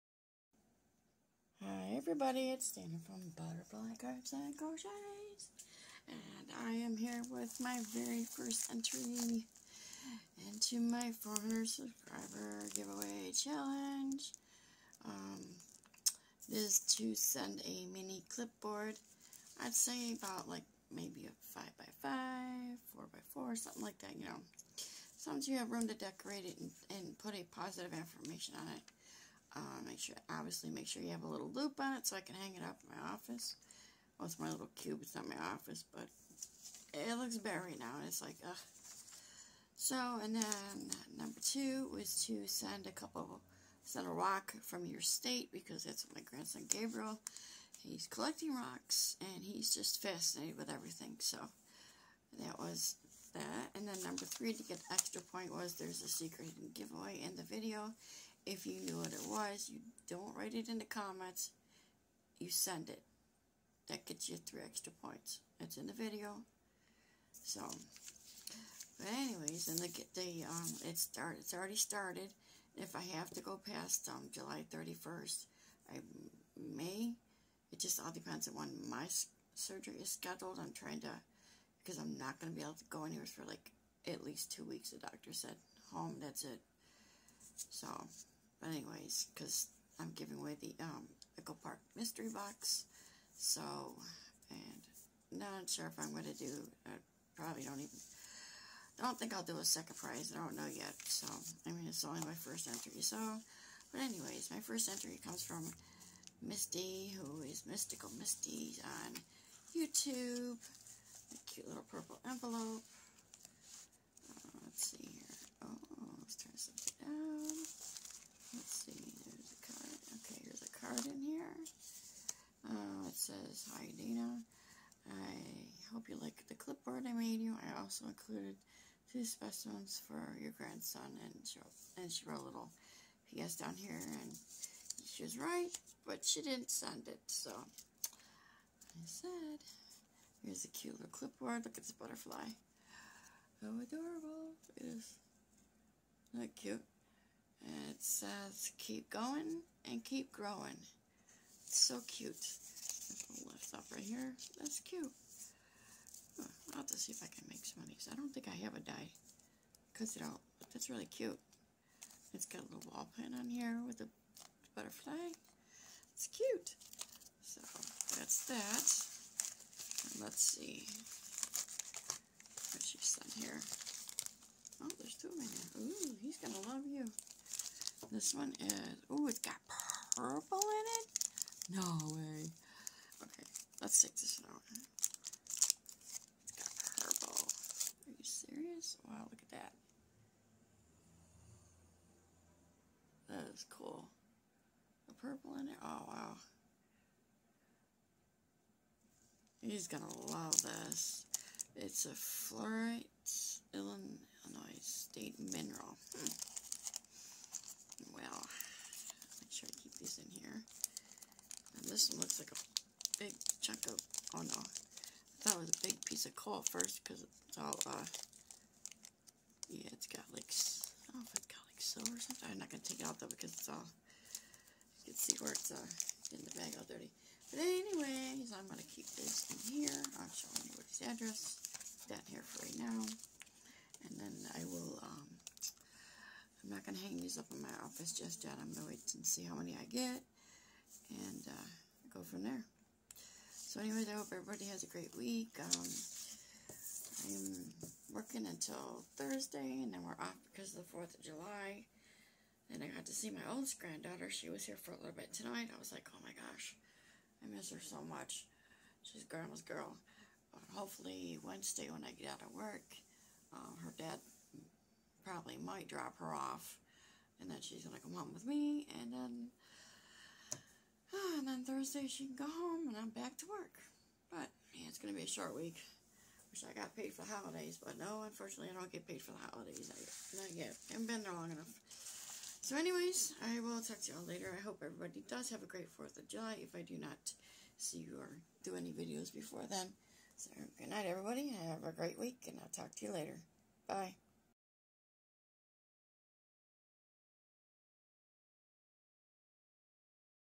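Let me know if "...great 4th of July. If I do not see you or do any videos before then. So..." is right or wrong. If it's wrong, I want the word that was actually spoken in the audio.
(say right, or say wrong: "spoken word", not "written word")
right.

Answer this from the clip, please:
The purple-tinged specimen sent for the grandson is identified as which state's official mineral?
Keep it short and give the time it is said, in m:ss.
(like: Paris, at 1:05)
Illinois, at 3:23.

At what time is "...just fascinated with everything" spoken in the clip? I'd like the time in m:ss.
0:49.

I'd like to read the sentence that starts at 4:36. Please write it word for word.
Wish I got paid for the holidays, but no, unfortunately I don't get paid for the holidays.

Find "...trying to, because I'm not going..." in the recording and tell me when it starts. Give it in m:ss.
1:20.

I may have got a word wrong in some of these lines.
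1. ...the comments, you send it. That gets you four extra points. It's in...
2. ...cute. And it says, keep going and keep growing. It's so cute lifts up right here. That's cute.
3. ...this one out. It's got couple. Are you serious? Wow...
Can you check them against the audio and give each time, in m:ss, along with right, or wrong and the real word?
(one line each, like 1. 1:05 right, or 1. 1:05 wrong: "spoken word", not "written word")
1. 1:00 wrong: "three", not "four"
2. 2:26 right
3. 3:04 wrong: "purple", not "couple".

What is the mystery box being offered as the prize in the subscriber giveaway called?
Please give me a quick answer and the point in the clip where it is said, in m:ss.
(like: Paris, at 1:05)
Pickle Park, at 1:31.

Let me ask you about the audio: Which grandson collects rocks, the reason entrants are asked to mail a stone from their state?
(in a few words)
Gabriel.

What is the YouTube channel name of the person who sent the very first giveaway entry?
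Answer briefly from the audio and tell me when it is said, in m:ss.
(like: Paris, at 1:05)
Mystical Misty, at 1:47.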